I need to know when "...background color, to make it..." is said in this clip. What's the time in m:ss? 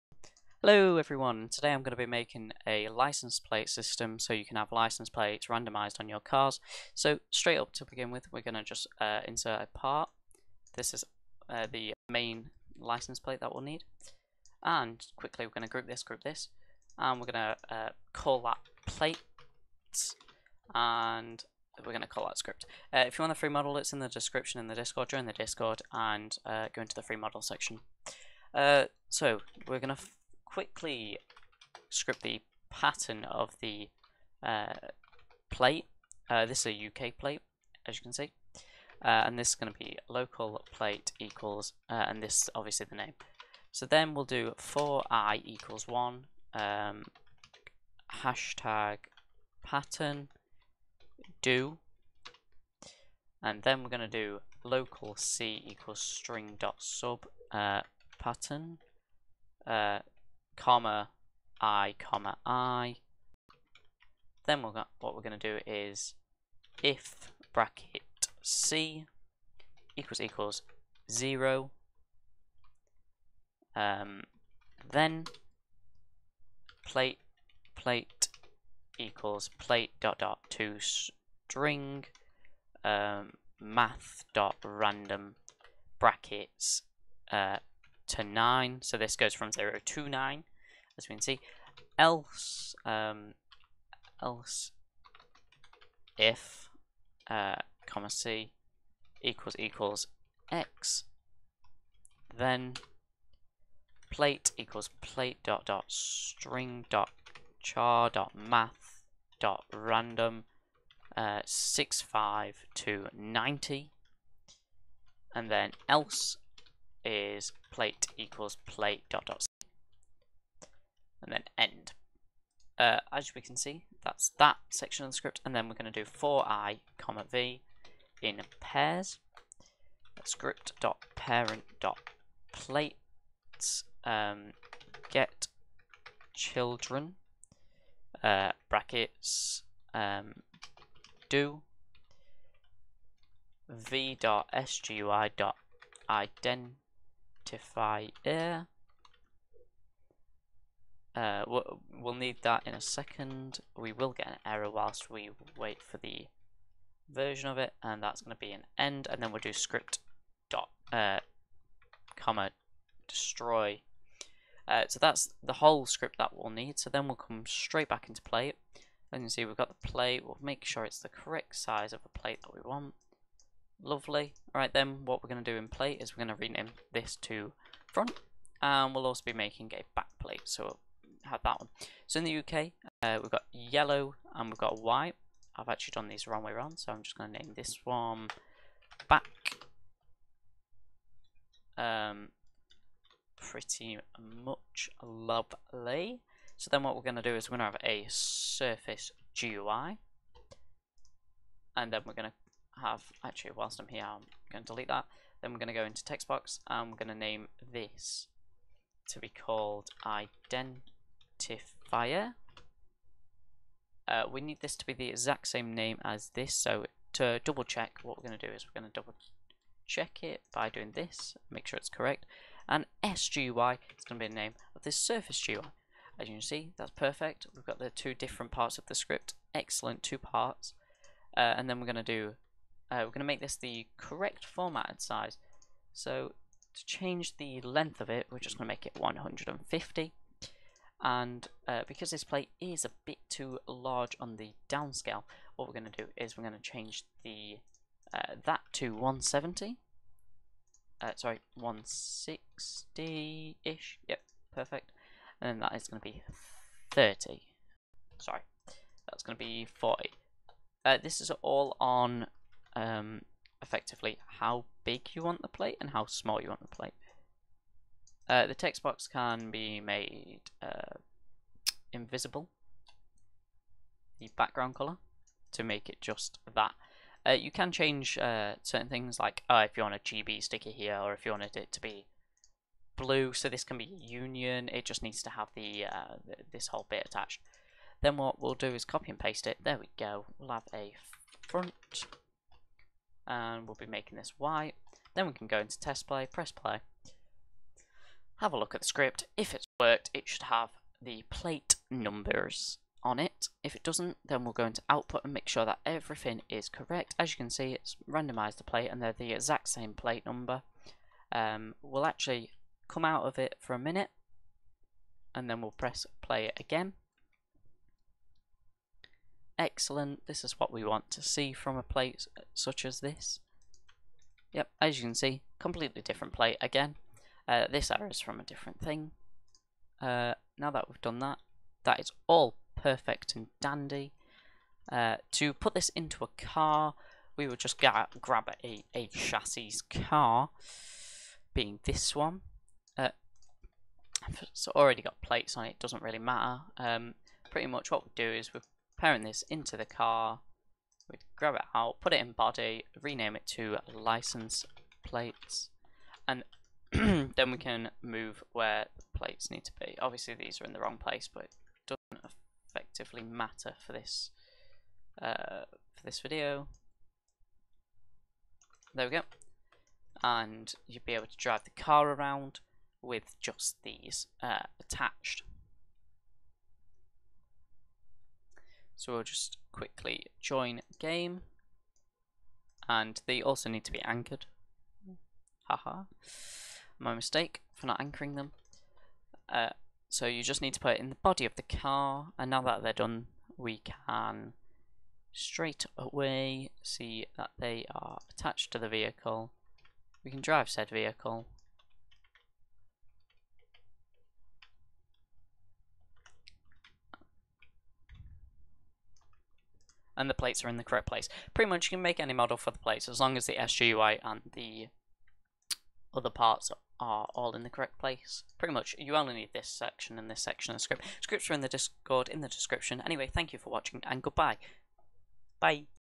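4:34.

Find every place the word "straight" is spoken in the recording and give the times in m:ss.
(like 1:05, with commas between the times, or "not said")
0:07, 2:47, 6:35.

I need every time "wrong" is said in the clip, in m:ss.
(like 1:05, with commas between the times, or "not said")
3:06, 6:00.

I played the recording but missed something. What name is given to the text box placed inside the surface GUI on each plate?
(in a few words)
identifier.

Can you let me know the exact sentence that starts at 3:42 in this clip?
And SGUI is going to be the name of this surface GUI.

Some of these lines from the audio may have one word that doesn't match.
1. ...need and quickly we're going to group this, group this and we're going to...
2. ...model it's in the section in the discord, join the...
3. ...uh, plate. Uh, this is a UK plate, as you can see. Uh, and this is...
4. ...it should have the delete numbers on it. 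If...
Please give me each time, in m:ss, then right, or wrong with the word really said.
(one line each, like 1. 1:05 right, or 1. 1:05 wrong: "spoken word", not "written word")
1. 0:13 right
2. 0:23 wrong: "description", not "section"
3. 0:34 right
4. 5:00 wrong: "plate", not "delete".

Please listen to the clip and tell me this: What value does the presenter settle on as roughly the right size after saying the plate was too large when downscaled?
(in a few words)
160.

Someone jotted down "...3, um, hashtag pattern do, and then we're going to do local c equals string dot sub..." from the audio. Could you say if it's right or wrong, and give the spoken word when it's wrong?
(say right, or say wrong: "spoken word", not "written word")
wrong: "1", not "3".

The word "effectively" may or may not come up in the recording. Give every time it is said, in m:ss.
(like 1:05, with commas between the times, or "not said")
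4:23, 6:02.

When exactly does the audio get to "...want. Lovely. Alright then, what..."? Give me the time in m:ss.
2:52.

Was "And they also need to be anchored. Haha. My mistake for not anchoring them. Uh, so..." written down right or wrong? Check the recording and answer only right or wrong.
right.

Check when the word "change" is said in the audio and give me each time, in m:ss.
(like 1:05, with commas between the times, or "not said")
3:56, 4:06, 4:37.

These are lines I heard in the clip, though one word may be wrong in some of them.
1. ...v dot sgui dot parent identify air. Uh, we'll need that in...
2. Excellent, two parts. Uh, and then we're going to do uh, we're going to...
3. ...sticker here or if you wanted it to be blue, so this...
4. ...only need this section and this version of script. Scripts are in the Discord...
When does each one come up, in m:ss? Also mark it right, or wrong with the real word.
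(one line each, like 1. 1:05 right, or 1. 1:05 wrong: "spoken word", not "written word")
1. 2:23 wrong: "ident", not "parent"
2. 3:49 right
3. 4:40 right
4. 6:59 wrong: "section", not "version".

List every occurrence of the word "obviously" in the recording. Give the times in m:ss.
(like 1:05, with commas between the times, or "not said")
0:42, 5:59.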